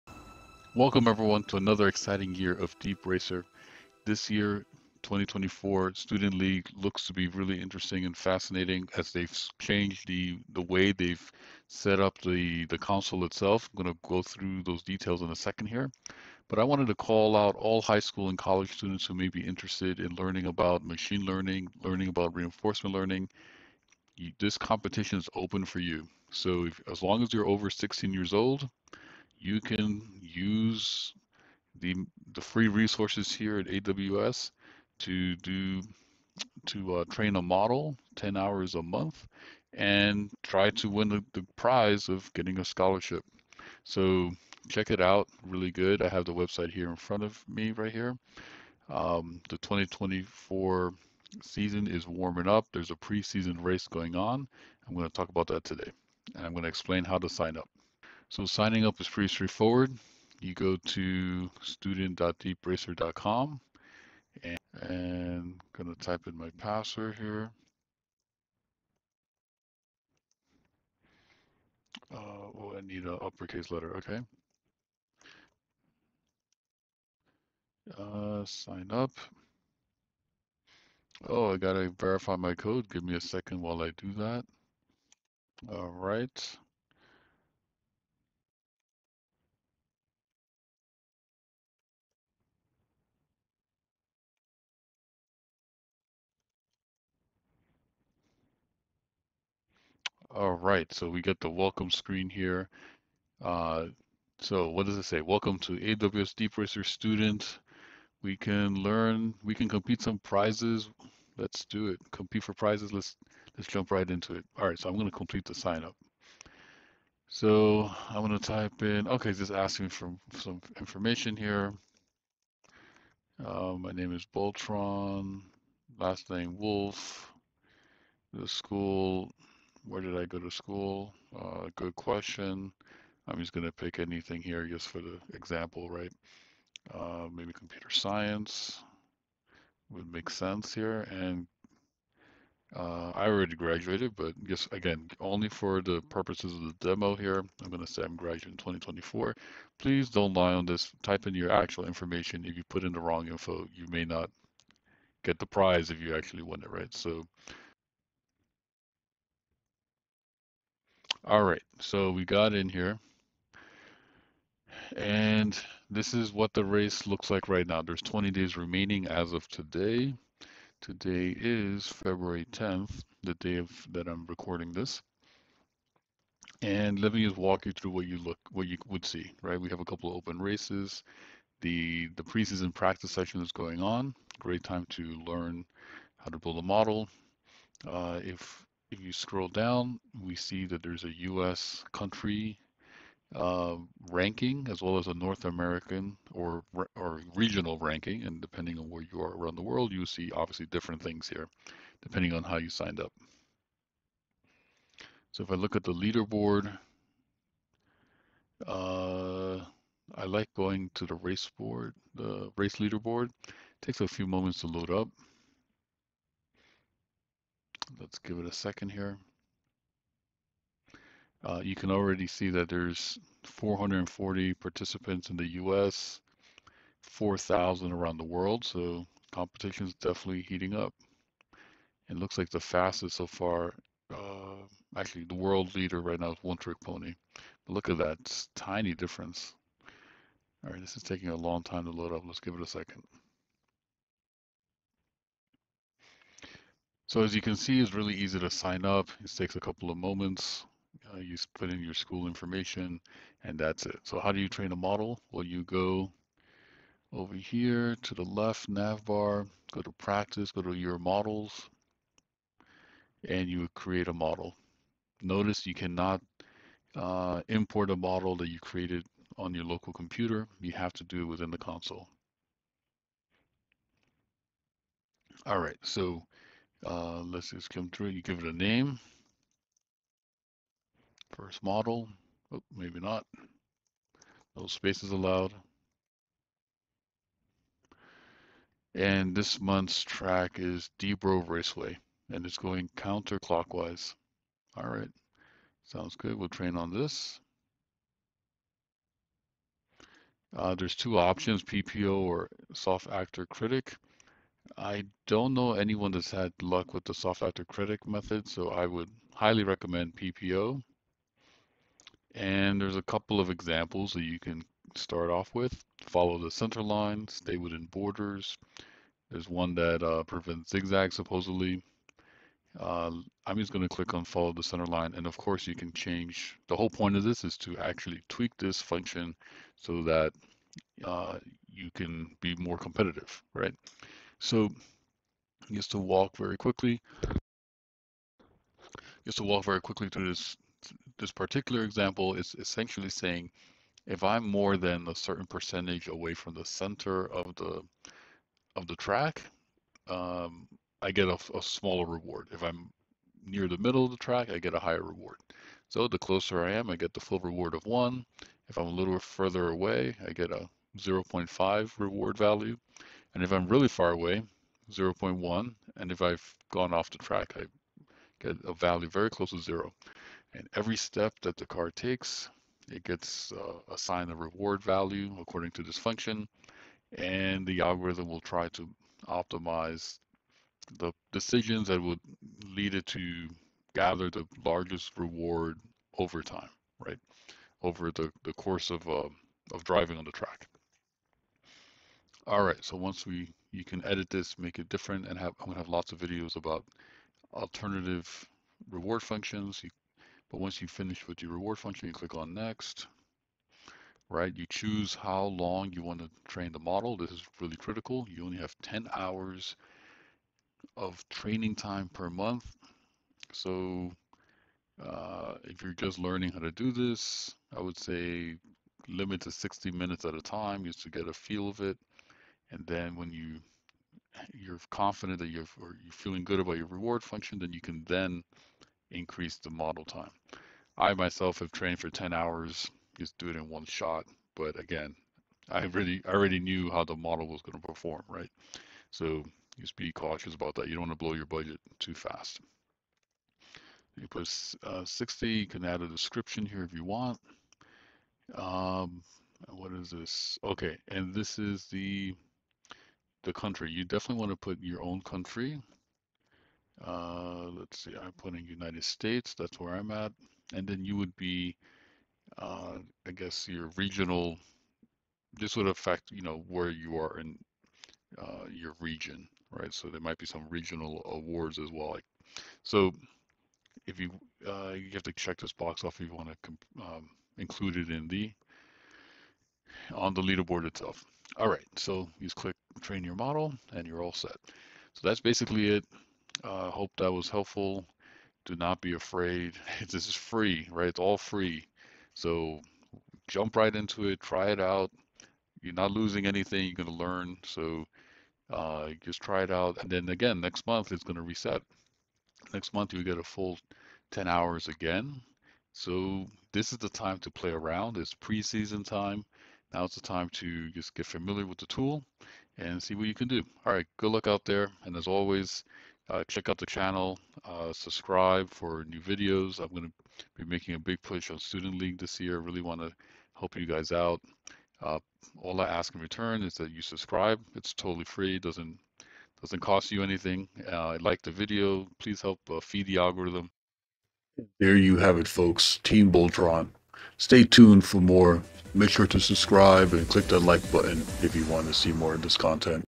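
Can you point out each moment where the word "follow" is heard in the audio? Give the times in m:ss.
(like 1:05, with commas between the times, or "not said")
5:16, 5:24.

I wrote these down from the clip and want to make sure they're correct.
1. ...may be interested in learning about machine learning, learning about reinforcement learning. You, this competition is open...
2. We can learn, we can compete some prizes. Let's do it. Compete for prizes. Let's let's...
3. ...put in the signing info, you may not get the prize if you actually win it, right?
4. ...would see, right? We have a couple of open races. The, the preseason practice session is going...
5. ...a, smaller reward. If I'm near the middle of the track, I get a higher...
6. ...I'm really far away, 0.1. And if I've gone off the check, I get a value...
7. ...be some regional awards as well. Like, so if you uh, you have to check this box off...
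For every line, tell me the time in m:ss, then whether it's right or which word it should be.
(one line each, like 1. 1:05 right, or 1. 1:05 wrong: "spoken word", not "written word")
1. 0:19 right
2. 1:48 right
3. 2:32 wrong: "wrong", not "signing"
4. 2:58 right
5. 5:51 right
6. 6:03 wrong: "track", not "check"
7. 7:50 right.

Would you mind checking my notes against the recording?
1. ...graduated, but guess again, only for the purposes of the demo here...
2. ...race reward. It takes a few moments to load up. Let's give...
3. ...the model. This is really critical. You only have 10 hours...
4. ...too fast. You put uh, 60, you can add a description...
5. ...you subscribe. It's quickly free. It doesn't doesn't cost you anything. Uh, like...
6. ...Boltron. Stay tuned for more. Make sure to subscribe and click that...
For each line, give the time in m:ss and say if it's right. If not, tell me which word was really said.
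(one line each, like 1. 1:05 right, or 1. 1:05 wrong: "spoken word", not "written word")
1. 2:23 right
2. 3:32 wrong: "leaderboard", not "reward"
3. 6:46 right
4. 7:21 right
5. 8:46 wrong: "totally", not "quickly"
6. 8:56 right.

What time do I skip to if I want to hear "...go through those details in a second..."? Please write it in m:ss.
0:14.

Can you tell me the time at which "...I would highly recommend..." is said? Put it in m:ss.
5:08.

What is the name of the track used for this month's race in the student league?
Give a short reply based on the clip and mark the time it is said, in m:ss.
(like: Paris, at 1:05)
DBro Raceway, at 4:50.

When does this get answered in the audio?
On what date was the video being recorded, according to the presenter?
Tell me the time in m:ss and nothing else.
2:51.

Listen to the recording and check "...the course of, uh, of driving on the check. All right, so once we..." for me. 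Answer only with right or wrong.
wrong.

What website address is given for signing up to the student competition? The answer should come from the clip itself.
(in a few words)
student.deepracer.com.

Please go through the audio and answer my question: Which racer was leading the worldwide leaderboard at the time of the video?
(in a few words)
One Trick Pony.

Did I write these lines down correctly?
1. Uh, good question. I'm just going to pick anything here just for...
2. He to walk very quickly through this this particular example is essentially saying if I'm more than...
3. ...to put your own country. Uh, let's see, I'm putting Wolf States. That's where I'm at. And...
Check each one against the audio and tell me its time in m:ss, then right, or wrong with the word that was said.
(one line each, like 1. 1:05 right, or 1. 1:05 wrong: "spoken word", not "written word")
1. 2:11 right
2. 5:39 right
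3. 7:34 wrong: "United", not "Wolf".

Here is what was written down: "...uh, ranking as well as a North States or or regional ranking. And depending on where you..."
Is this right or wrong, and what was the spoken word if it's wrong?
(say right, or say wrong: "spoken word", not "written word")
wrong: "American", not "States".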